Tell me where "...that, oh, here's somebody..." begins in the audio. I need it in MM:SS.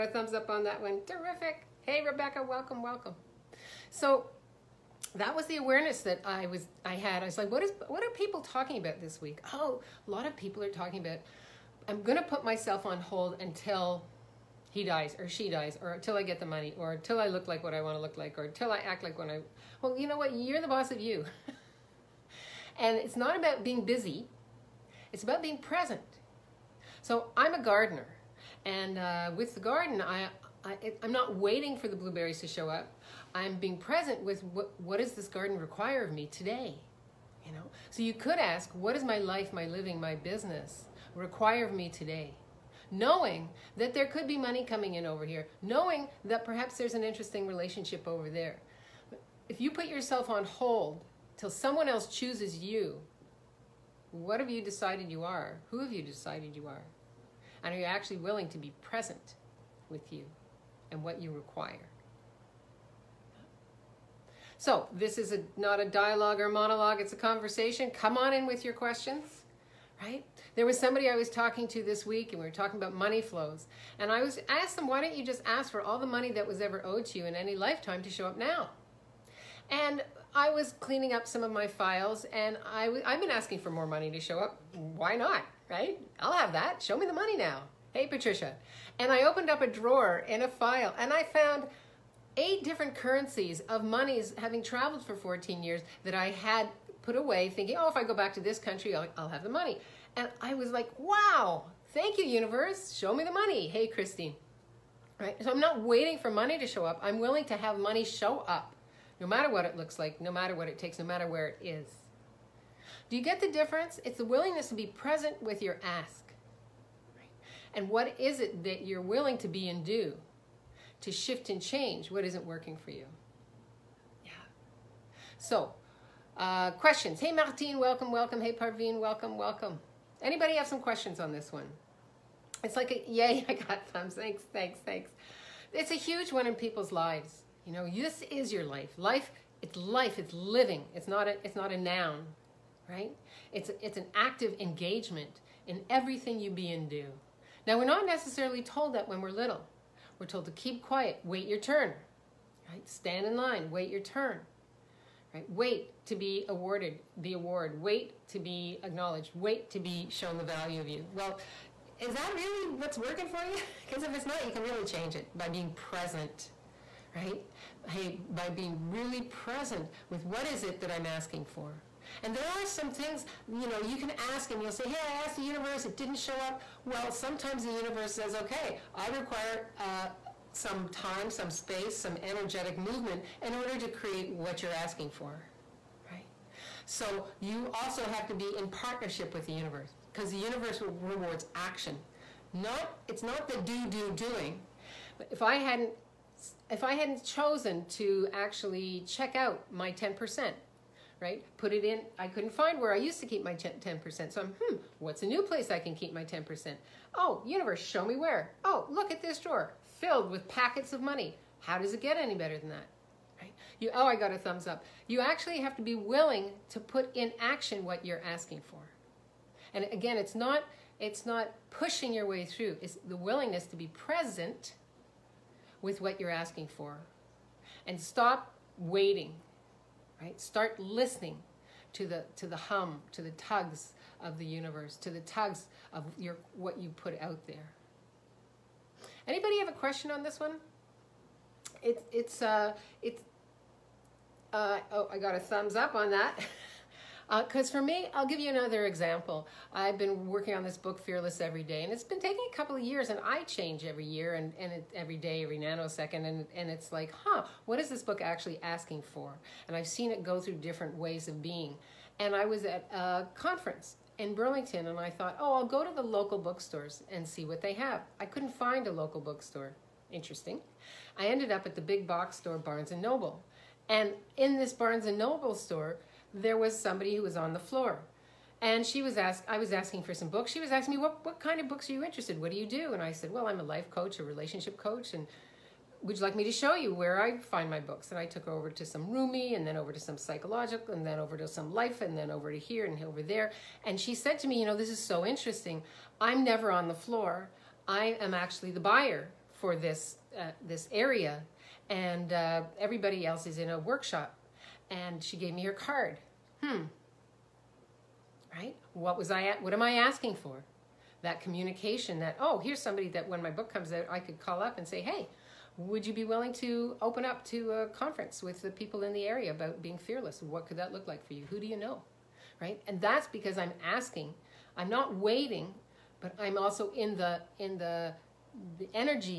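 05:12.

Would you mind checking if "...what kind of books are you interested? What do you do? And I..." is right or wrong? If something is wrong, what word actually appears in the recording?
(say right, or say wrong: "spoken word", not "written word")
right.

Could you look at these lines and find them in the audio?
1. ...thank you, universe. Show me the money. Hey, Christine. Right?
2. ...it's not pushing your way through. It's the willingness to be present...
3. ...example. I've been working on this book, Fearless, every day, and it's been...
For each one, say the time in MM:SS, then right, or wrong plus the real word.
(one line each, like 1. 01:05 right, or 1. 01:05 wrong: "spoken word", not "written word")
1. 01:41 right
2. 03:40 right
3. 04:08 right.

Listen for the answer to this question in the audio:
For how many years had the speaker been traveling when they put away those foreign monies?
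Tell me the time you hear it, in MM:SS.
01:35.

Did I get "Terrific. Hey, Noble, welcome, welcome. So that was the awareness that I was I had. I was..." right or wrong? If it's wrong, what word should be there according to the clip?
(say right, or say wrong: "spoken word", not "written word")
wrong: "Rebecca", not "Noble".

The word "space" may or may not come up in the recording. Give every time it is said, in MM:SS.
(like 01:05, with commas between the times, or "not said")
03:01.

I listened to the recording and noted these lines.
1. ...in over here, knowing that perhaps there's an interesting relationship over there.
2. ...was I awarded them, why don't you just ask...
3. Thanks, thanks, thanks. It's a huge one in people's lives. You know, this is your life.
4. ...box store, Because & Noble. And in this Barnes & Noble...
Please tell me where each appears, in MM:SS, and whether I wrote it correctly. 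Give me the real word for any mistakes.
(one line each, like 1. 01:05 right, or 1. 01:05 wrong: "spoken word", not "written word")
1. 00:44 right
2. 01:14 wrong: "asked", not "awarded"
3. 02:14 right
4. 04:32 wrong: "Barnes", not "Because".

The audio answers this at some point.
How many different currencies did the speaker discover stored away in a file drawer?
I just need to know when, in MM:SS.
01:32.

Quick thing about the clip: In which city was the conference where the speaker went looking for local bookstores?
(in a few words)
Burlington.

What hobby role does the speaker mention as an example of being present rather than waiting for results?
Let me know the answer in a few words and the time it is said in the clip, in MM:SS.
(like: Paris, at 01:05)
gardener, at 00:27.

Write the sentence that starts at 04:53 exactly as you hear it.
And she said to me, you know, this is so interesting.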